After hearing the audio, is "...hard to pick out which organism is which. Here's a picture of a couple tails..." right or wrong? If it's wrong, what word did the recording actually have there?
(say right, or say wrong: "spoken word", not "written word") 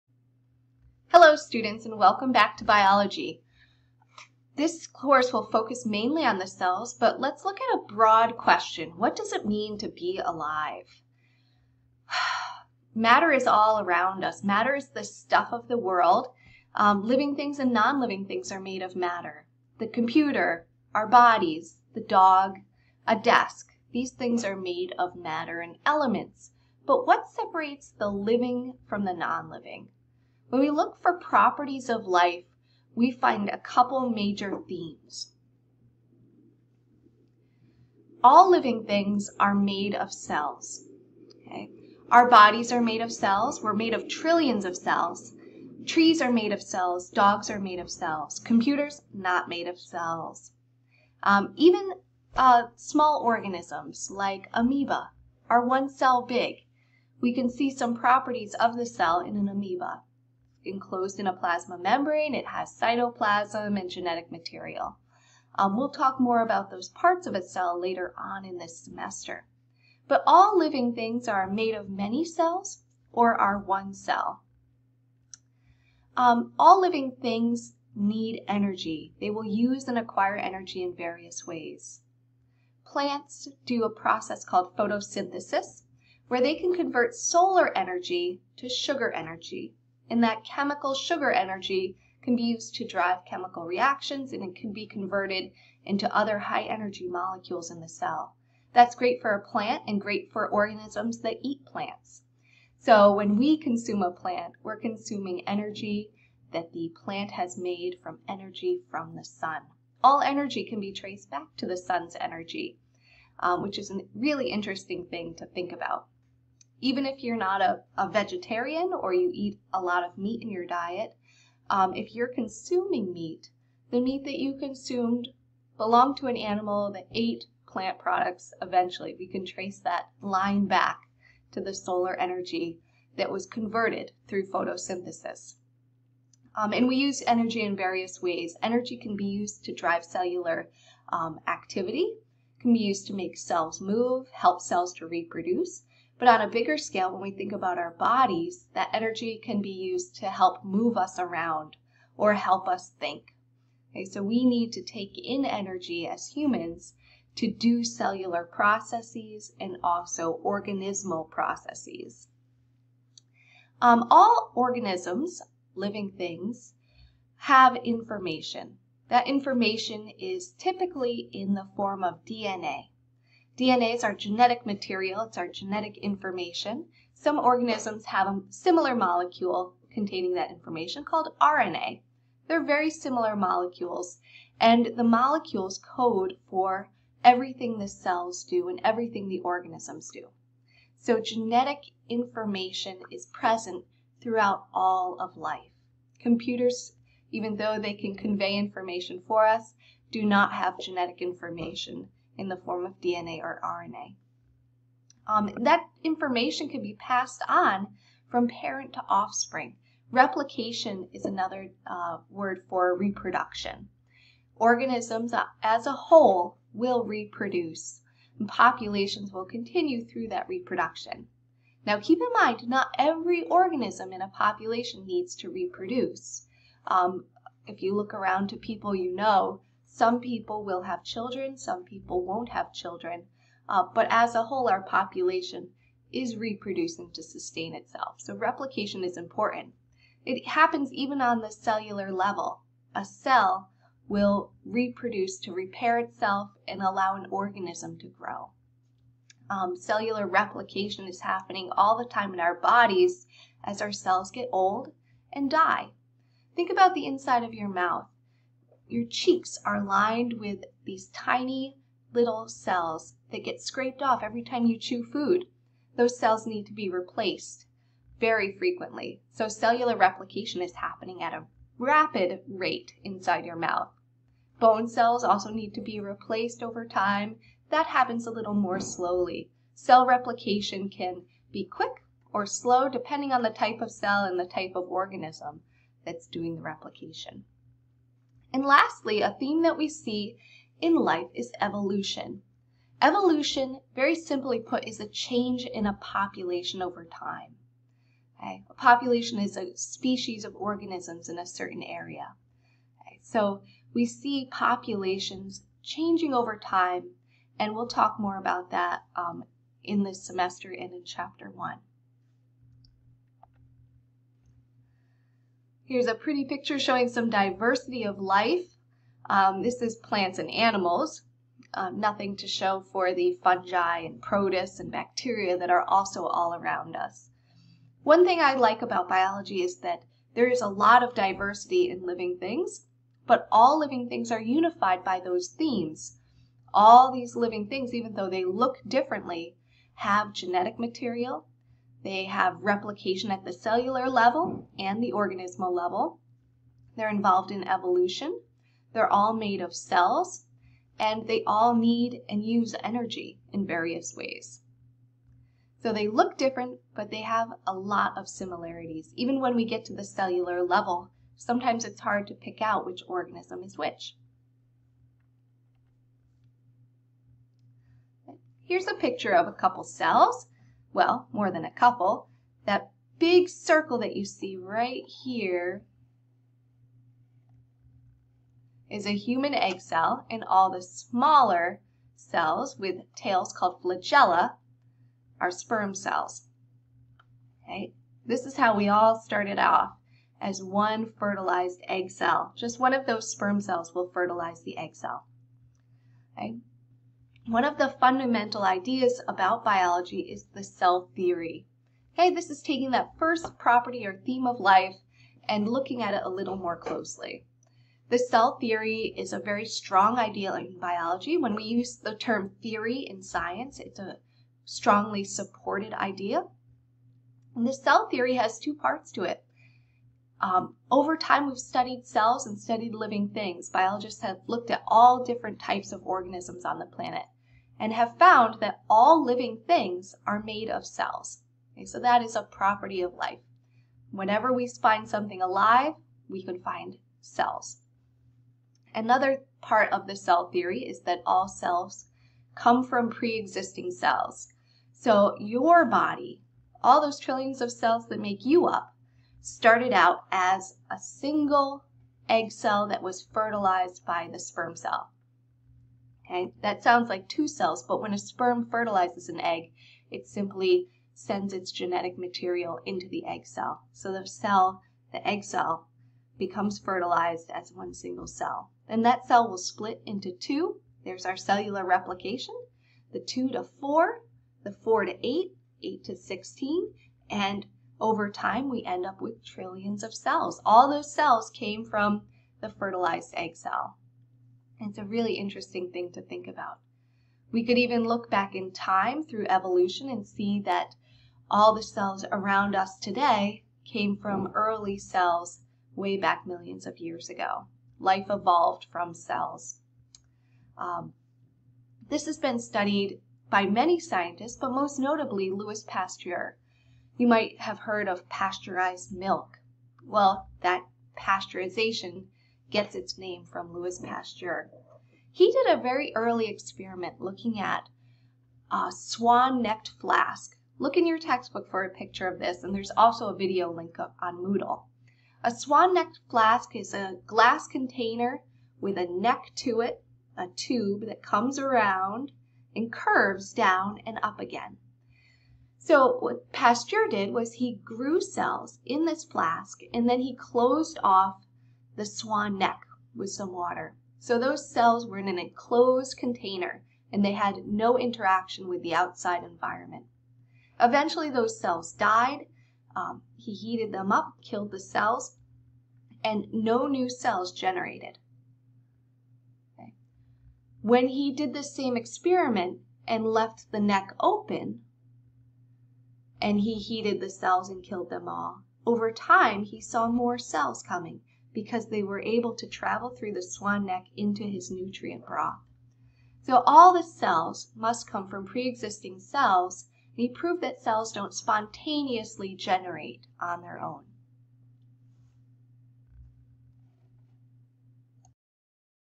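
wrong: "cells", not "tails".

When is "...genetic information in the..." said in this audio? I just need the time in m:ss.
3:20.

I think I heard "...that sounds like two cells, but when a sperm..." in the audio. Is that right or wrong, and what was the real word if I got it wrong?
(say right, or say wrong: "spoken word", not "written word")
right.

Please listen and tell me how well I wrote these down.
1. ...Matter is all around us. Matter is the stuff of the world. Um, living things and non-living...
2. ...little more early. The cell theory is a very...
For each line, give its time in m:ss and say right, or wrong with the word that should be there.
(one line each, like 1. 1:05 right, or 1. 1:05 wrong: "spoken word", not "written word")
1. 0:12 right
2. 6:46 wrong: "closely", not "early".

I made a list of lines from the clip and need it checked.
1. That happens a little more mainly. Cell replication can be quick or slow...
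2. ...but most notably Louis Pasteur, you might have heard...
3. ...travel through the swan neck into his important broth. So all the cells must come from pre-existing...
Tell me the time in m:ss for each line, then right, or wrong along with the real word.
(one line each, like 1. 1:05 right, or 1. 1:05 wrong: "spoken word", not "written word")
1. 4:37 wrong: "slowly", not "mainly"
2. 8:24 right
3. 9:32 wrong: "nutrient", not "important".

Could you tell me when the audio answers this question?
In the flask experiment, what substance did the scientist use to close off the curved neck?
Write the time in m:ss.
9:03.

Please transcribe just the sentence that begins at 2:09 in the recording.
We can trace that line back to the solar energy that was converted through photosynthesis.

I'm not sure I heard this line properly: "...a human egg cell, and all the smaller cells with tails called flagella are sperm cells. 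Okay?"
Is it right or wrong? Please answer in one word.
right.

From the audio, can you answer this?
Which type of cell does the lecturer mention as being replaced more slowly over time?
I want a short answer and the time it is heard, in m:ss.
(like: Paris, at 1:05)
Bone cells, at 4:34.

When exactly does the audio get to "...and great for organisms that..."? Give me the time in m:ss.
1:39.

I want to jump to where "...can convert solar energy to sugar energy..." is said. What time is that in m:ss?
1:26.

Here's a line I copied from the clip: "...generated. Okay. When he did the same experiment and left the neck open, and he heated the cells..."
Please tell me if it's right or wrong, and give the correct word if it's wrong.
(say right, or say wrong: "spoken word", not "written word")
right.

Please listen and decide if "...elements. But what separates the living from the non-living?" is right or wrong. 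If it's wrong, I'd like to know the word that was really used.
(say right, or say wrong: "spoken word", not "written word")
right.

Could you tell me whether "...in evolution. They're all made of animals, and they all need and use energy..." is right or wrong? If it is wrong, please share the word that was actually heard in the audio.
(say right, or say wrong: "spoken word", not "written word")
wrong: "cells", not "animals".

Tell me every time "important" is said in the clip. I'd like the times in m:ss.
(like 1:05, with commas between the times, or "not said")
3:59.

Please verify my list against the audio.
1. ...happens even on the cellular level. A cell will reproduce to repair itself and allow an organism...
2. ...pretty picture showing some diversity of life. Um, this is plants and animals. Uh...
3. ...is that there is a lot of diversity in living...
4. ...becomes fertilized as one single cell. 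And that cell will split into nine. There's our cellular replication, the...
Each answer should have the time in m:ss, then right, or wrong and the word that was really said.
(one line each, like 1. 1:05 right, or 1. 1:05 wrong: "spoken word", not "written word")
1. 4:00 right
2. 5:16 right
3. 5:29 right
4. 7:46 wrong: "two", not "nine".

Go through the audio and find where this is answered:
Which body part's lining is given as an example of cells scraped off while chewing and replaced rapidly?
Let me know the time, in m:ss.
4:19.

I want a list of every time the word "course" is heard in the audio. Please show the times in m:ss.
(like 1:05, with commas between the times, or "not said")
0:04.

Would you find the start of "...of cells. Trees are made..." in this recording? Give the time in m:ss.
0:44.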